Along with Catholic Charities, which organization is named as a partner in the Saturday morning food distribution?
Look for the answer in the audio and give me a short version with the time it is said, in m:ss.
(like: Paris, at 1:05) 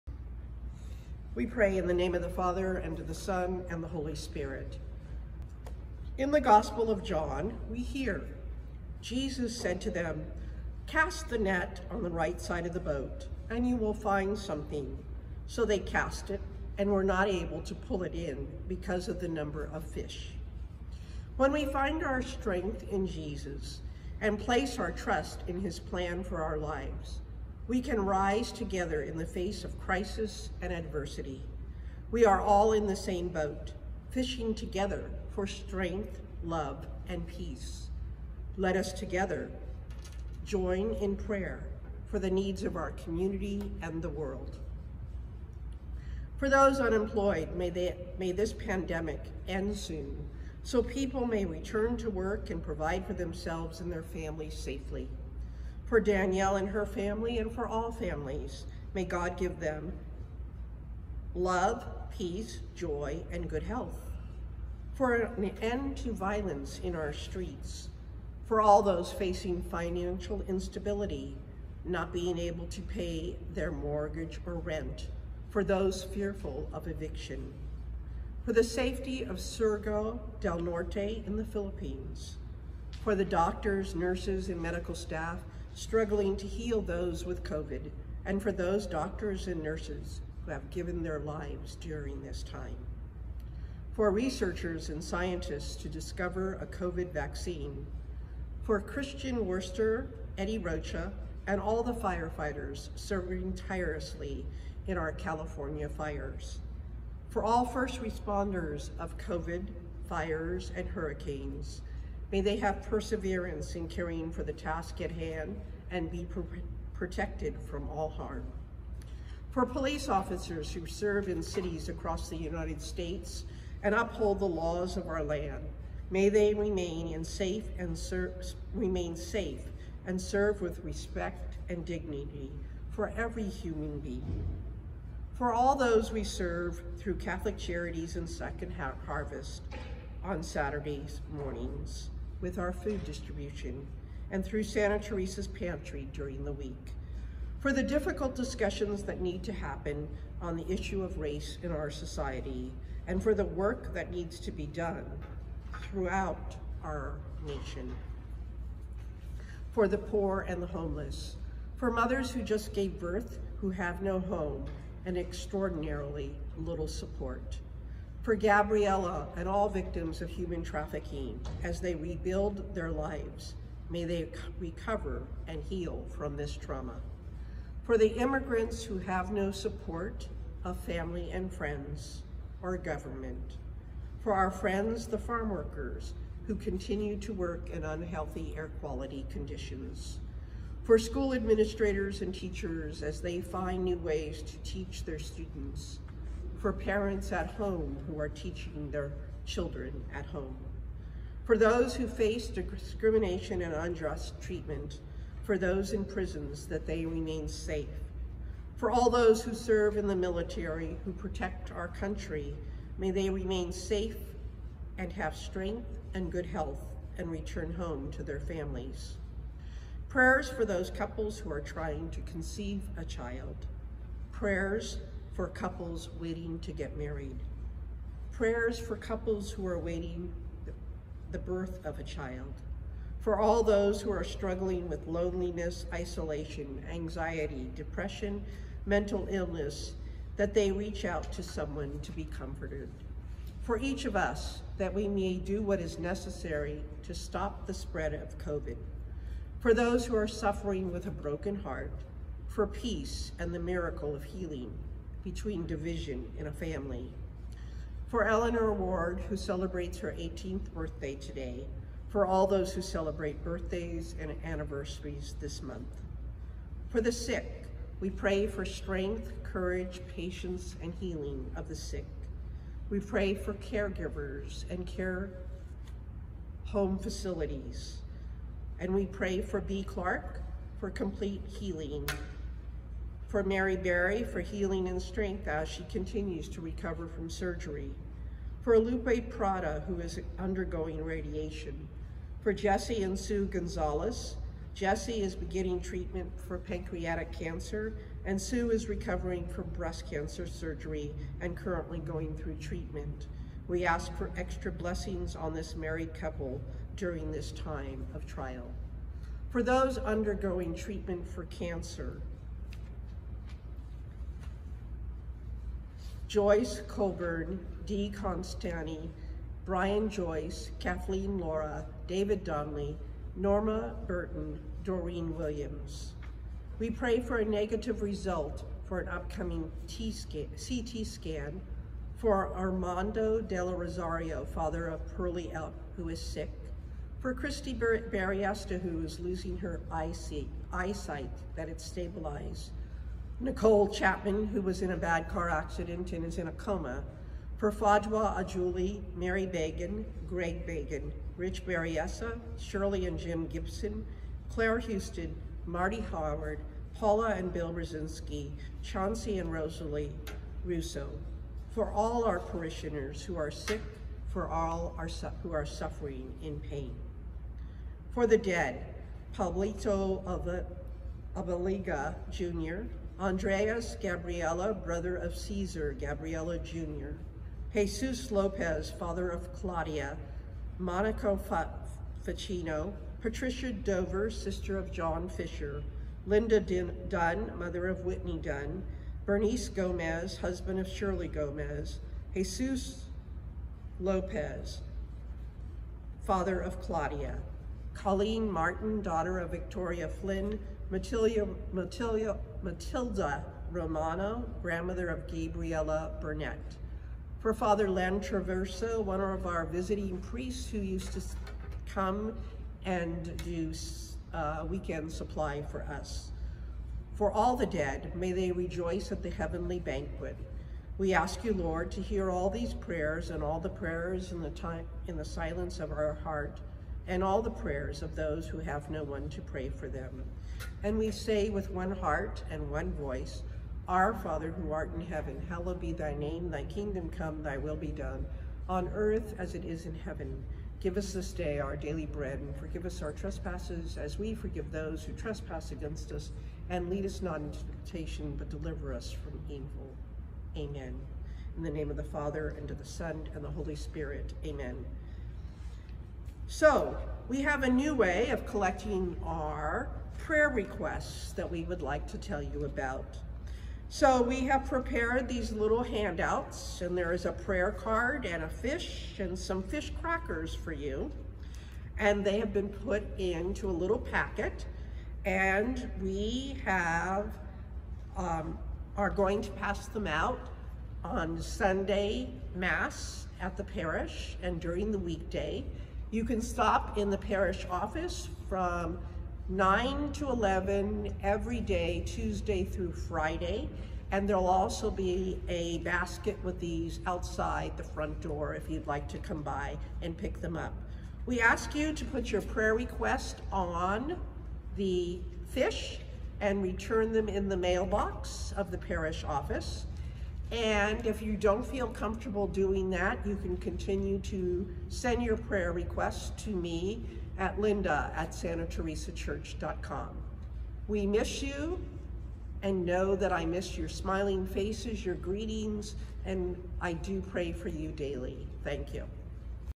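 Second Harvest, at 2:18.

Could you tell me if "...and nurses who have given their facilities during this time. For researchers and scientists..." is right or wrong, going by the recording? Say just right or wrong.
wrong.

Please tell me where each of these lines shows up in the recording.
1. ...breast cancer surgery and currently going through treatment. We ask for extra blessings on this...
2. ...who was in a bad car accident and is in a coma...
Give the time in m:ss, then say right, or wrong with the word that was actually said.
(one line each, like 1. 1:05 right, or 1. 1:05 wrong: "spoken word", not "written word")
1. 4:59 right
2. 5:44 right.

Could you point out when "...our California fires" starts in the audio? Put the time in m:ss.
1:44.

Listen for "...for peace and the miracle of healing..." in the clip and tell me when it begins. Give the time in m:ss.
4:12.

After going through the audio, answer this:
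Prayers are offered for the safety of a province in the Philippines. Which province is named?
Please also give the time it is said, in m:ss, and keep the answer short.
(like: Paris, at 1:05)
Surigao del Norte, at 1:19.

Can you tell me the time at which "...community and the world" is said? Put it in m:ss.
0:42.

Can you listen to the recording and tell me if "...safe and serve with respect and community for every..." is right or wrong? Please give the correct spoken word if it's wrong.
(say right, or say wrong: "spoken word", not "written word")
wrong: "dignity", not "community".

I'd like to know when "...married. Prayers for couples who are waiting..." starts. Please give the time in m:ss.
3:46.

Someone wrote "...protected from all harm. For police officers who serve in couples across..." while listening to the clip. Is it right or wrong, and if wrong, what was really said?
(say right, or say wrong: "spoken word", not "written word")
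wrong: "cities", not "couples".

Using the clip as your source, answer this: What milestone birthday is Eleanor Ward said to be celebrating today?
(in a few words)
18th.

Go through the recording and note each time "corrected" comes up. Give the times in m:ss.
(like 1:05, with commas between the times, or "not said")
not said.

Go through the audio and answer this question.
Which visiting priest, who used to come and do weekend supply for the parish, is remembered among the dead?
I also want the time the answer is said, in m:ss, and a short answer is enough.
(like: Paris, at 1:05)
Father Len Traverso, at 6:47.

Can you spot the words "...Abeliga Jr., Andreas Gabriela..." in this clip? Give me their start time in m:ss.
6:11.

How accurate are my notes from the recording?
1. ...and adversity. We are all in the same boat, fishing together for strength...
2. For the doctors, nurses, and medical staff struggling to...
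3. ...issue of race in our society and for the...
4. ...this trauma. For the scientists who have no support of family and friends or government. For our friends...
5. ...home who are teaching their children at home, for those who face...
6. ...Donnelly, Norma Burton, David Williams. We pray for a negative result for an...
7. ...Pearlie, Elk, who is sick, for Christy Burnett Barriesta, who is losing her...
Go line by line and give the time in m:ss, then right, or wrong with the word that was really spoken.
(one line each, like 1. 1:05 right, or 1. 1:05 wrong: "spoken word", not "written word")
1. 0:30 right
2. 1:23 right
3. 2:30 right
4. 2:56 wrong: "immigrants", not "scientists"
5. 3:17 right
6. 5:22 wrong: "Doreen", not "David"
7. 5:35 wrong: "Bar", not "Burnett".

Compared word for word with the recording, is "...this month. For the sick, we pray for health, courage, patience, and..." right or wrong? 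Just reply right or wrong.
wrong.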